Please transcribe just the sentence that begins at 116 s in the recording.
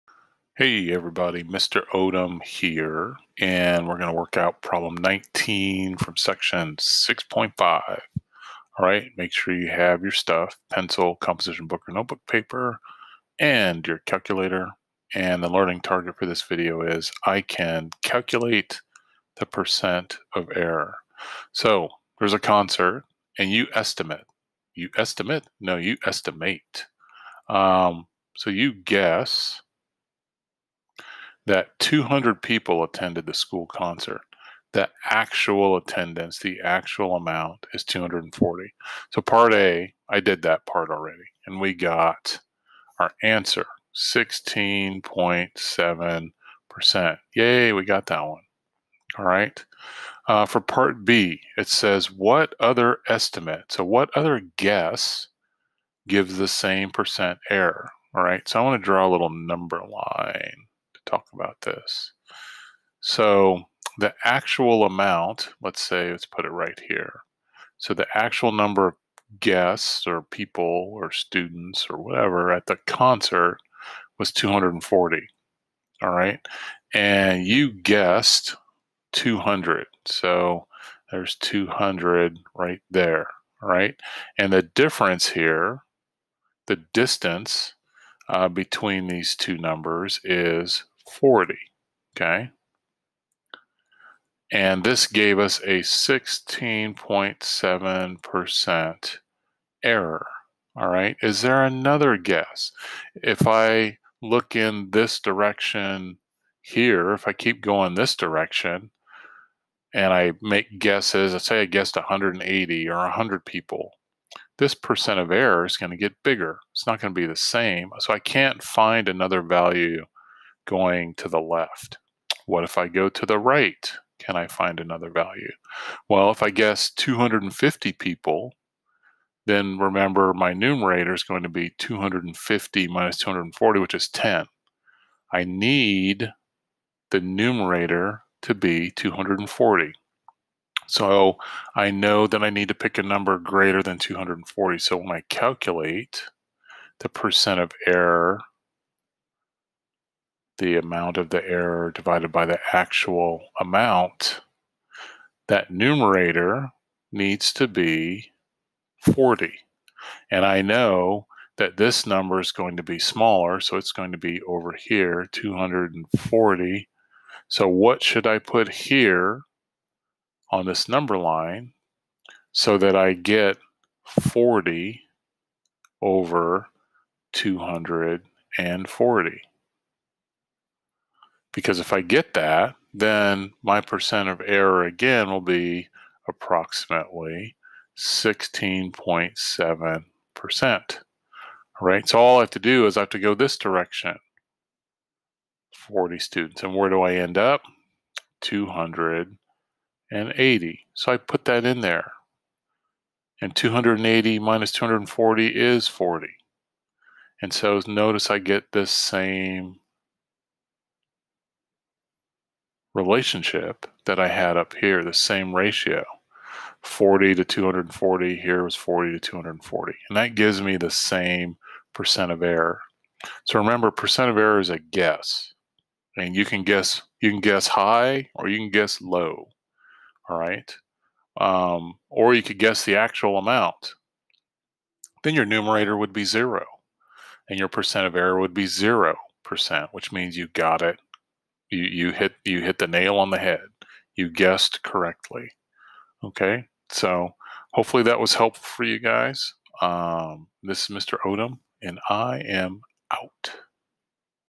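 It's not going to be the same.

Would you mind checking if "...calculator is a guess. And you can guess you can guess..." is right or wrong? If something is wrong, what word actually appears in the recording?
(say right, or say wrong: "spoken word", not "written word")
wrong: "error", not "calculator".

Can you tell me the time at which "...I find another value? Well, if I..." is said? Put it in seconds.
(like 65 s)
124 s.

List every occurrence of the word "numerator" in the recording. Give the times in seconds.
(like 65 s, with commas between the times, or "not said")
130 s, 137 s, 155 s, 235 s.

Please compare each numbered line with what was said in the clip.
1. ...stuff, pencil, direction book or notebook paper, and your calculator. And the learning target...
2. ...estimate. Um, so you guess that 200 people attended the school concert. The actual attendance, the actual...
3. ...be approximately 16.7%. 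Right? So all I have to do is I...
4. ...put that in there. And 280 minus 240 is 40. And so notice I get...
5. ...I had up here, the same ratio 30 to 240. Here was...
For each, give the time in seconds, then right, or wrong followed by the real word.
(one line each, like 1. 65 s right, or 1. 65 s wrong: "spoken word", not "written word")
1. 10 s wrong: "composition", not "direction"
2. 26 s right
3. 185 s right
4. 201 s right
5. 214 s wrong: "40", not "30".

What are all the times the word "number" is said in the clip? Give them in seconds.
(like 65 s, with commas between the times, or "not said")
59 s, 68 s, 89 s, 143 s, 162 s, 170 s.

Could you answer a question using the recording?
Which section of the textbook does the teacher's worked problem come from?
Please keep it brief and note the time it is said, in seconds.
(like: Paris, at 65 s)
6.5, at 6 s.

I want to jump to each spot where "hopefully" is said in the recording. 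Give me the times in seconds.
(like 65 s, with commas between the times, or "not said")
247 s.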